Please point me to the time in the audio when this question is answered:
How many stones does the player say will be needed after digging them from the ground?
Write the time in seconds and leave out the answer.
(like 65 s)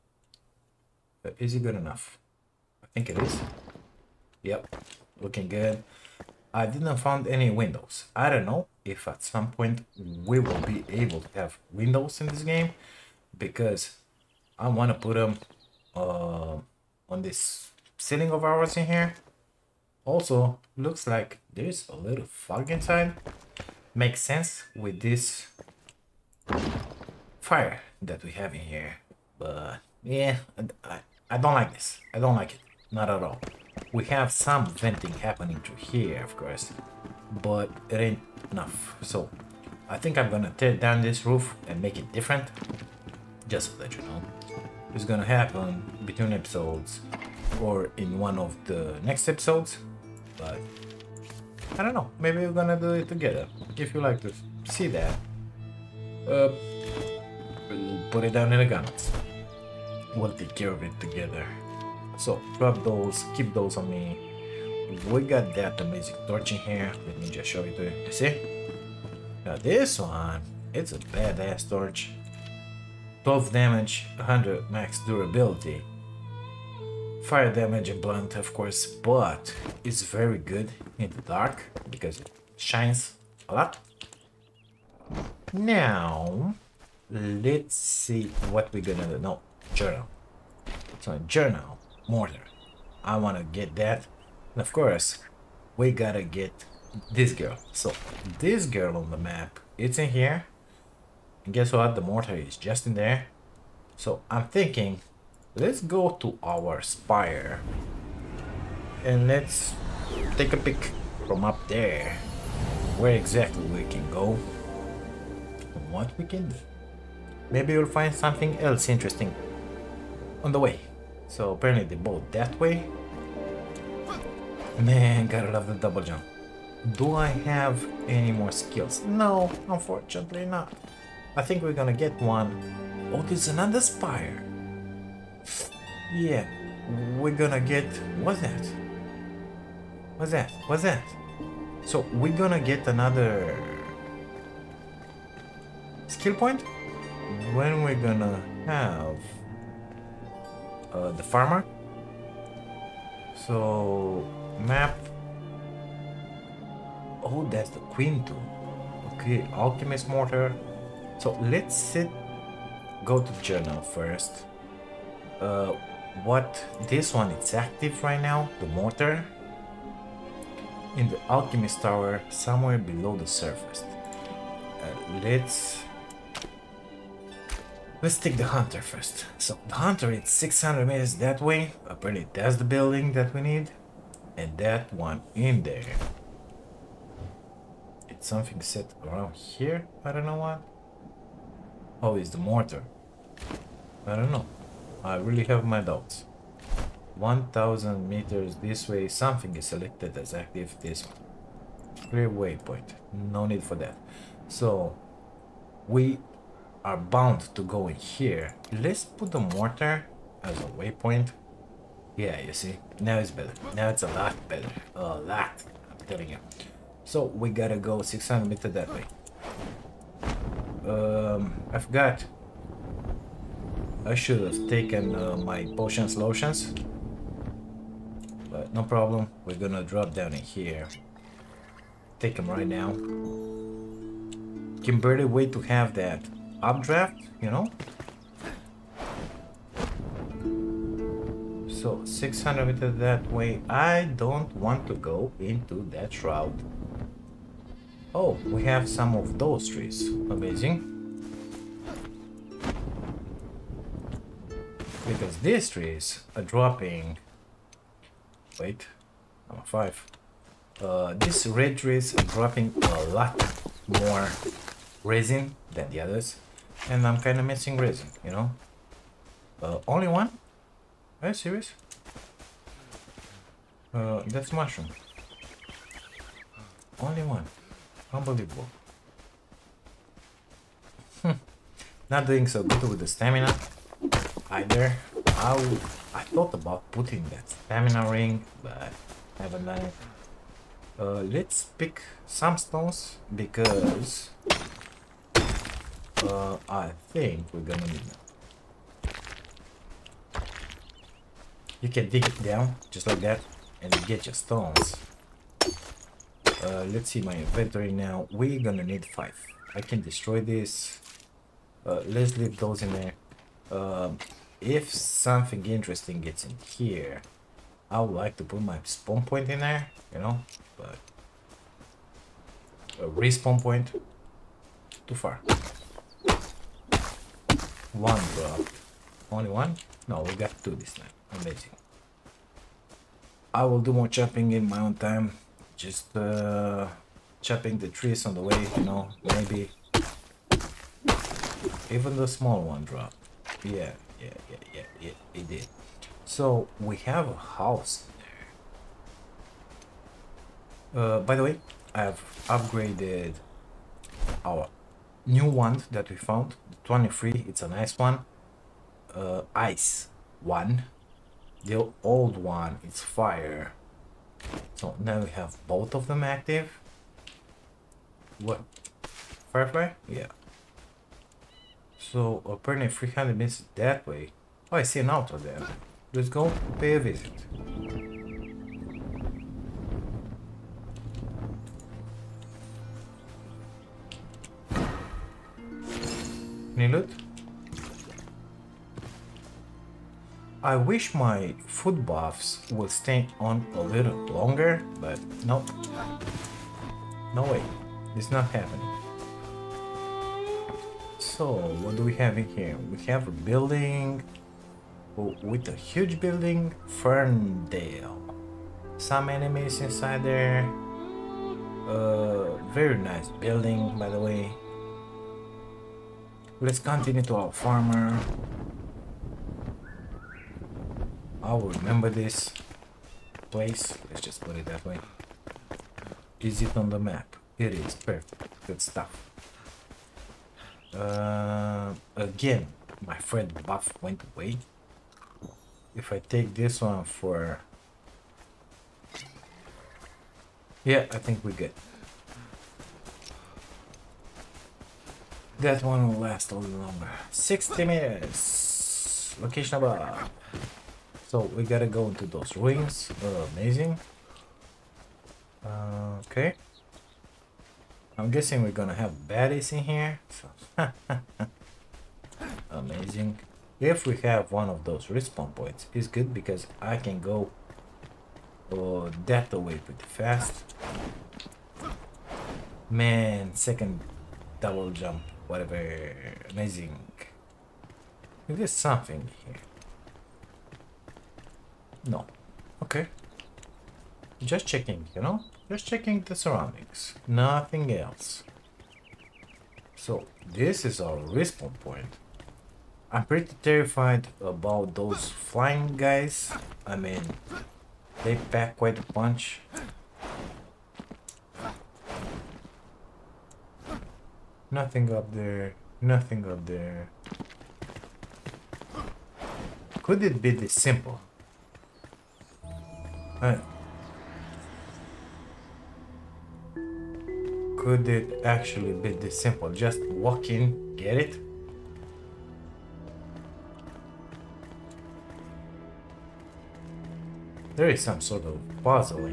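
309 s.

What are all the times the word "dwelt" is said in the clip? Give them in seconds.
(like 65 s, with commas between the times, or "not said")
not said.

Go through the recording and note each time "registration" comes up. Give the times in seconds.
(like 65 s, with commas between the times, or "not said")
not said.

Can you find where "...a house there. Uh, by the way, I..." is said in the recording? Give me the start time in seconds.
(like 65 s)
347 s.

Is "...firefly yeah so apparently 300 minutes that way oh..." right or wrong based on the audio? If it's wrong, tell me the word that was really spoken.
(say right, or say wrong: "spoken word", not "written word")
right.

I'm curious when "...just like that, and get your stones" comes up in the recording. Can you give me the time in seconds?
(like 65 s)
302 s.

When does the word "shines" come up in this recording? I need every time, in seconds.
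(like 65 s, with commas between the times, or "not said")
82 s.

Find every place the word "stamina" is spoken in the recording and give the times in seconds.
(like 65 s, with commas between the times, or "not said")
283 s, 287 s.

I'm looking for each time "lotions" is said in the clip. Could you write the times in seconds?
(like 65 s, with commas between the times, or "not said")
226 s.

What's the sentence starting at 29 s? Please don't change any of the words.
But yeah, I, I don't like this.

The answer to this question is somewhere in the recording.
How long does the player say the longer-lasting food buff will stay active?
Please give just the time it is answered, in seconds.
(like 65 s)
447 s.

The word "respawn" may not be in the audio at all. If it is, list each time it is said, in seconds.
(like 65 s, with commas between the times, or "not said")
323 s, 465 s, 491 s.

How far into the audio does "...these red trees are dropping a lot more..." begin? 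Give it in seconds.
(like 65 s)
261 s.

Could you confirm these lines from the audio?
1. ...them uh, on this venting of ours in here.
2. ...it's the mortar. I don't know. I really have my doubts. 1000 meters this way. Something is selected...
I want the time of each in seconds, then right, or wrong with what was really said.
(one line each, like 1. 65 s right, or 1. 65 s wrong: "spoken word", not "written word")
1. 15 s wrong: "ceiling", not "venting"
2. 192 s right.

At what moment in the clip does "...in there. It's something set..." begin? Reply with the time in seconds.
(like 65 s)
185 s.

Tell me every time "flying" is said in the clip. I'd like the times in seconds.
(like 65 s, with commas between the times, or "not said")
495 s.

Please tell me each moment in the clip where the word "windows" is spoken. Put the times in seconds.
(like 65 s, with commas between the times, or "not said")
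7 s, 11 s.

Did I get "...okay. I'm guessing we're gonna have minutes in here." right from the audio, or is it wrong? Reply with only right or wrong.
wrong.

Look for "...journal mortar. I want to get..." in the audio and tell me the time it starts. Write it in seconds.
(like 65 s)
91 s.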